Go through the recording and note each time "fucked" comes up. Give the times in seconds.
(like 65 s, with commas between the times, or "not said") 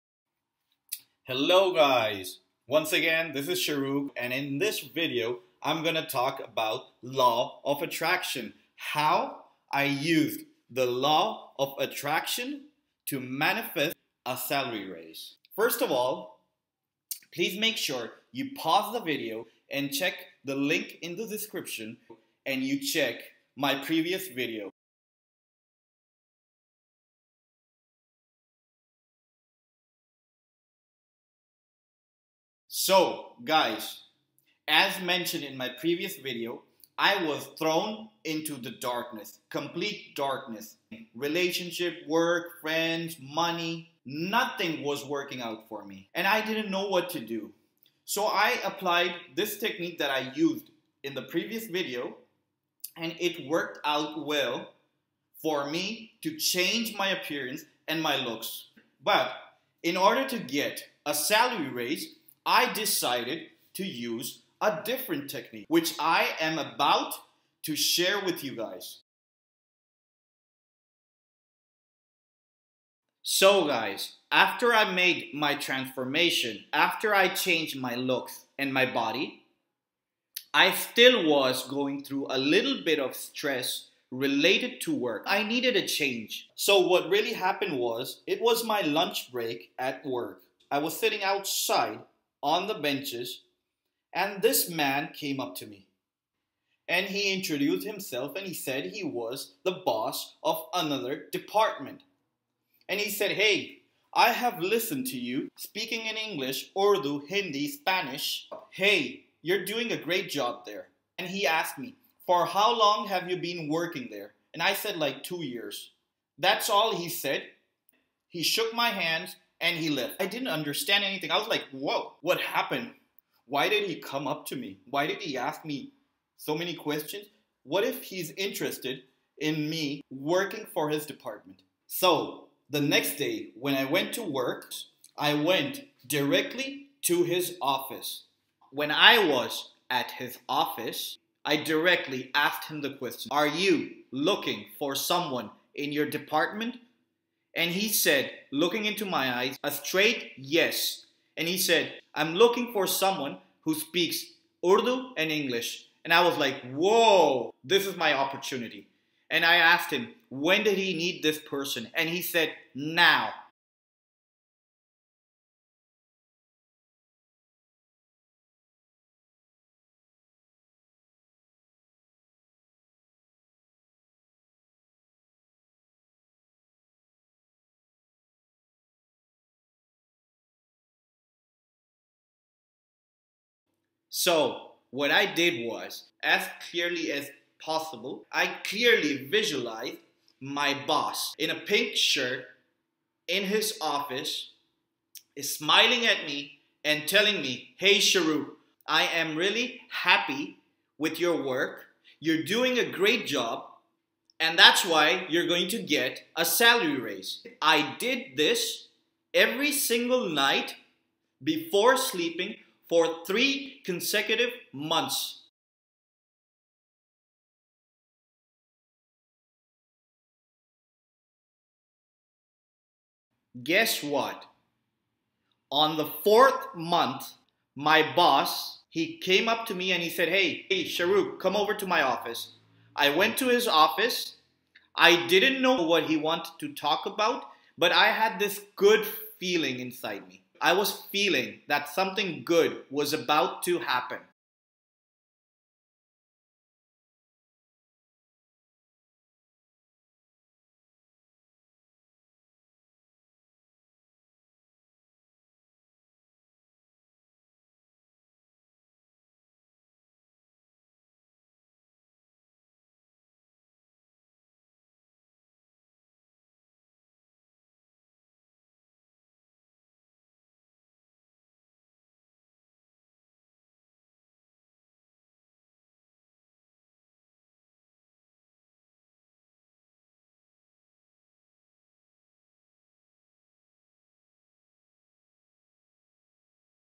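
not said.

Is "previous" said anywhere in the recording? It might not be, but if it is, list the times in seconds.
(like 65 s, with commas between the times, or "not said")
23 s, 35 s, 51 s.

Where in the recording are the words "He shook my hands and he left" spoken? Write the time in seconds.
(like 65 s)
118 s.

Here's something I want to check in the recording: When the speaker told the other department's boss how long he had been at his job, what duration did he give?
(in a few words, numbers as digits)
2 years.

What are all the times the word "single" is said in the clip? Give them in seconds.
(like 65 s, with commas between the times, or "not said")
209 s.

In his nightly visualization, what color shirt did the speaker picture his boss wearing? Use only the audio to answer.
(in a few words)
Pink.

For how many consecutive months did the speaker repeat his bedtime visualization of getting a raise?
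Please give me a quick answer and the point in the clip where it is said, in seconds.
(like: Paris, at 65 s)
3, at 213 s.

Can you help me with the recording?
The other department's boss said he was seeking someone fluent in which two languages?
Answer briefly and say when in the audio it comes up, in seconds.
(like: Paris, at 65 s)
Urdu and English, at 154 s.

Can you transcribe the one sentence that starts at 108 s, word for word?
Hey, you're doing a great job there.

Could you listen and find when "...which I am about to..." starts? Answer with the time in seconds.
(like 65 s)
65 s.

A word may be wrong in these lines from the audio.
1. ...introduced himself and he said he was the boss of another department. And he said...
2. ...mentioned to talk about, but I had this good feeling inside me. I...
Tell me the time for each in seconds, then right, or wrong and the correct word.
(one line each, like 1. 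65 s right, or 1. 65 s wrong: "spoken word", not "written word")
1. 97 s right
2. 236 s wrong: "wanted", not "mentioned".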